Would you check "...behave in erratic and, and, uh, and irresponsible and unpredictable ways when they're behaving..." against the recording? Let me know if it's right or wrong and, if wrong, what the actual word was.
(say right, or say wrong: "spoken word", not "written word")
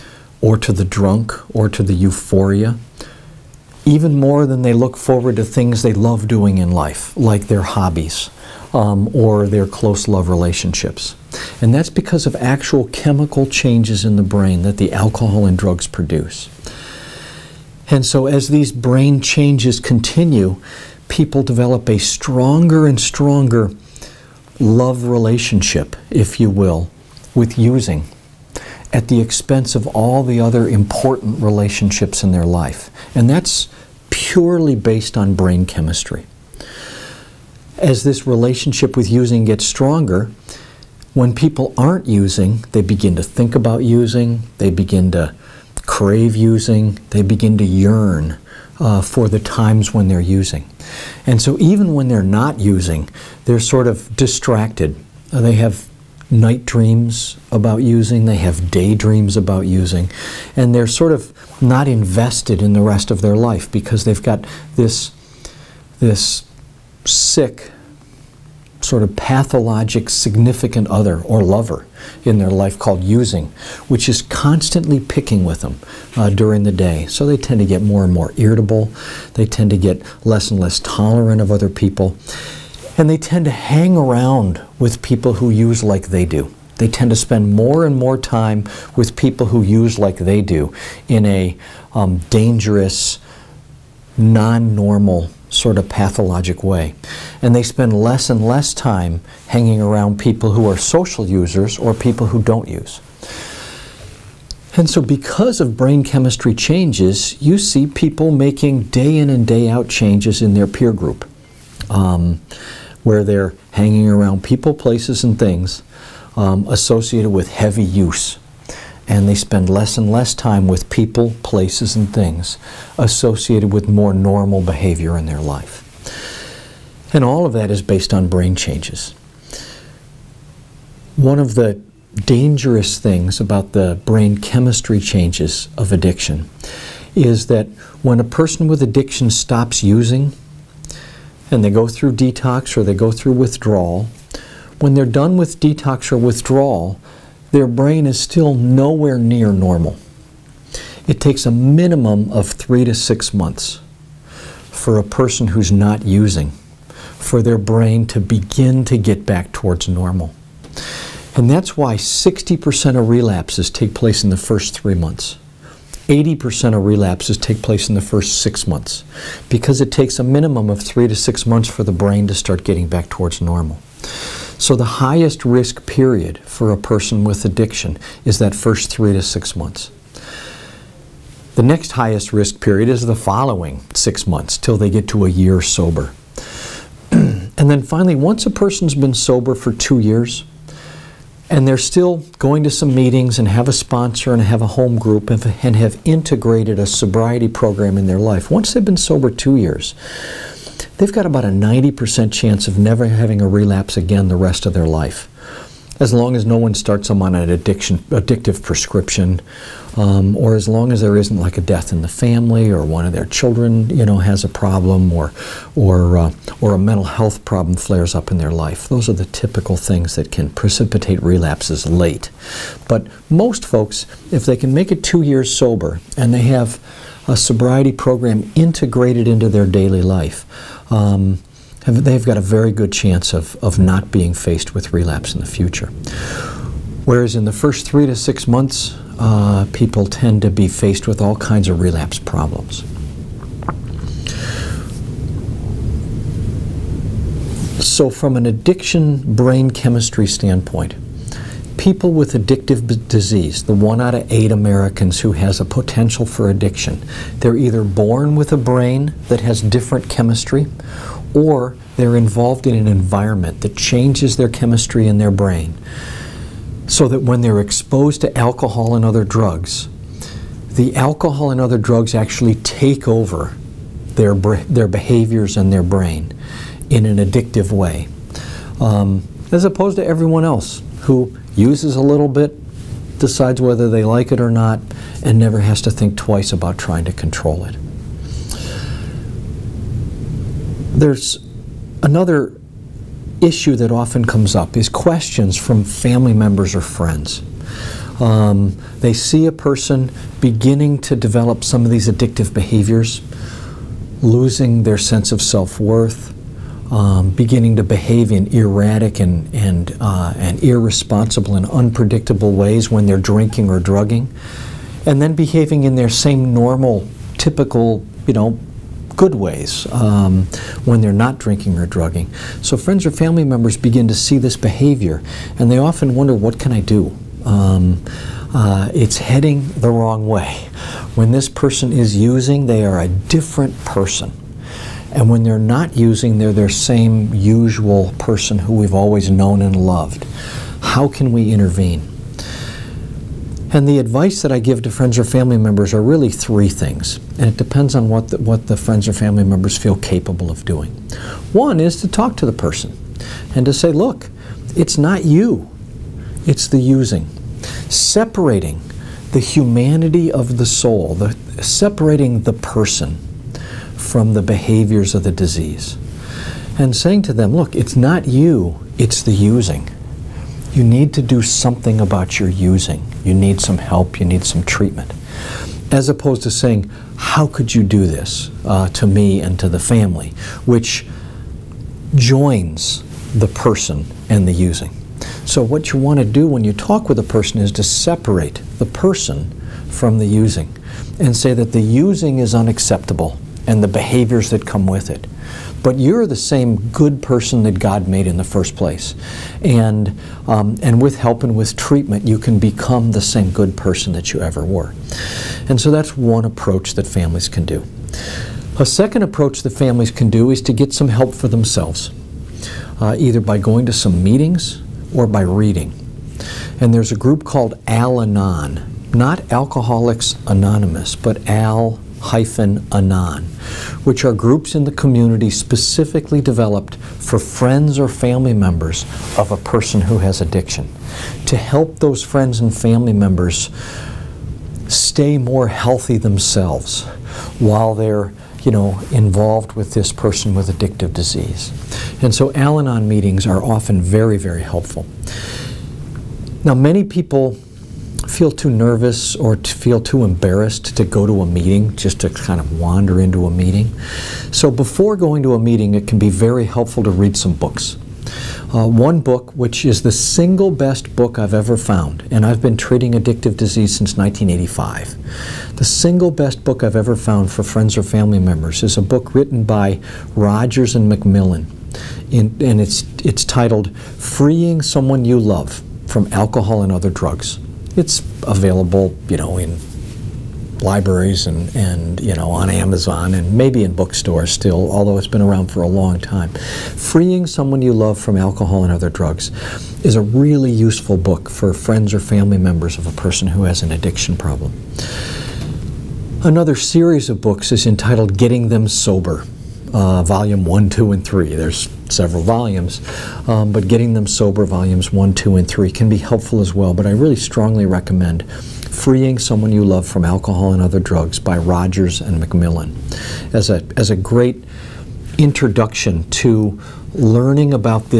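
wrong: "drinking", not "behaving".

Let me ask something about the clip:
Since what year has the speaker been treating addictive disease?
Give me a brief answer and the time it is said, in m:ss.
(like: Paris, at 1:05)
1985, at 7:44.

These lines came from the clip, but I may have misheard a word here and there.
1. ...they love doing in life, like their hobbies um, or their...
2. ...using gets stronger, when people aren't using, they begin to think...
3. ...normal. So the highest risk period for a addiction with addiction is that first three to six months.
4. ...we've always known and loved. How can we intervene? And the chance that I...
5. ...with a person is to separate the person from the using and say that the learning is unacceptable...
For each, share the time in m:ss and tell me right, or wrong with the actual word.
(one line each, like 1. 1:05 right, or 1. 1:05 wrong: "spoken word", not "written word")
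1. 0:05 right
2. 0:39 right
3. 2:53 wrong: "person", not "addiction"
4. 5:38 wrong: "advice", not "chance"
5. 6:27 wrong: "using", not "learning".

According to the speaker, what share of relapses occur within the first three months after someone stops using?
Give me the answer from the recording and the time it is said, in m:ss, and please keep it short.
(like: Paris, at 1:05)
60%, at 2:41.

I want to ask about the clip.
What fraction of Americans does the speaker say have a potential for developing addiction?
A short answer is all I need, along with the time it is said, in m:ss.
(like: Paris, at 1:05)
1 in 8, at 4:13.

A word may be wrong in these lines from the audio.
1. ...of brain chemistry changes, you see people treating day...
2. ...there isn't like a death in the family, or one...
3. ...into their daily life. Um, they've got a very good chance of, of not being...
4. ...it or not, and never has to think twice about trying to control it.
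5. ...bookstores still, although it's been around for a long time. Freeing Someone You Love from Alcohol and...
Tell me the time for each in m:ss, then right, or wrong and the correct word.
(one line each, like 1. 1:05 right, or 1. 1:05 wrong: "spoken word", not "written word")
1. 1:45 wrong: "making", not "treating"
2. 3:31 right
3. 3:49 right
4. 4:44 right
5. 8:03 right.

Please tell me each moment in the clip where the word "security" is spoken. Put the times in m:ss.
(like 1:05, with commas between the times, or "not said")
not said.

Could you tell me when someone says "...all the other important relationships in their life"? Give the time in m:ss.
0:29.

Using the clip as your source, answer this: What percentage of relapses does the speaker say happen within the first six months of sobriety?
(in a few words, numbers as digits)
80%.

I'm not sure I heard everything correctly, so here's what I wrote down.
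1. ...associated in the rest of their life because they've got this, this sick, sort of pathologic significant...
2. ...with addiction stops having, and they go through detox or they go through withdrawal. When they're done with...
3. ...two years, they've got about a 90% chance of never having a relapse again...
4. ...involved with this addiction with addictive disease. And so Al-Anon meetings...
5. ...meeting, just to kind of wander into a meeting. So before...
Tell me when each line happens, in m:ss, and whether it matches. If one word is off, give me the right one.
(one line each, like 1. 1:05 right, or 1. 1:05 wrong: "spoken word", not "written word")
1. 1:01 wrong: "invested", not "associated"
2. 2:18 wrong: "using", not "having"
3. 3:19 right
4. 7:19 wrong: "person", not "addiction"
5. 7:31 right.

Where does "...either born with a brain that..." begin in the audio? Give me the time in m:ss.
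4:17.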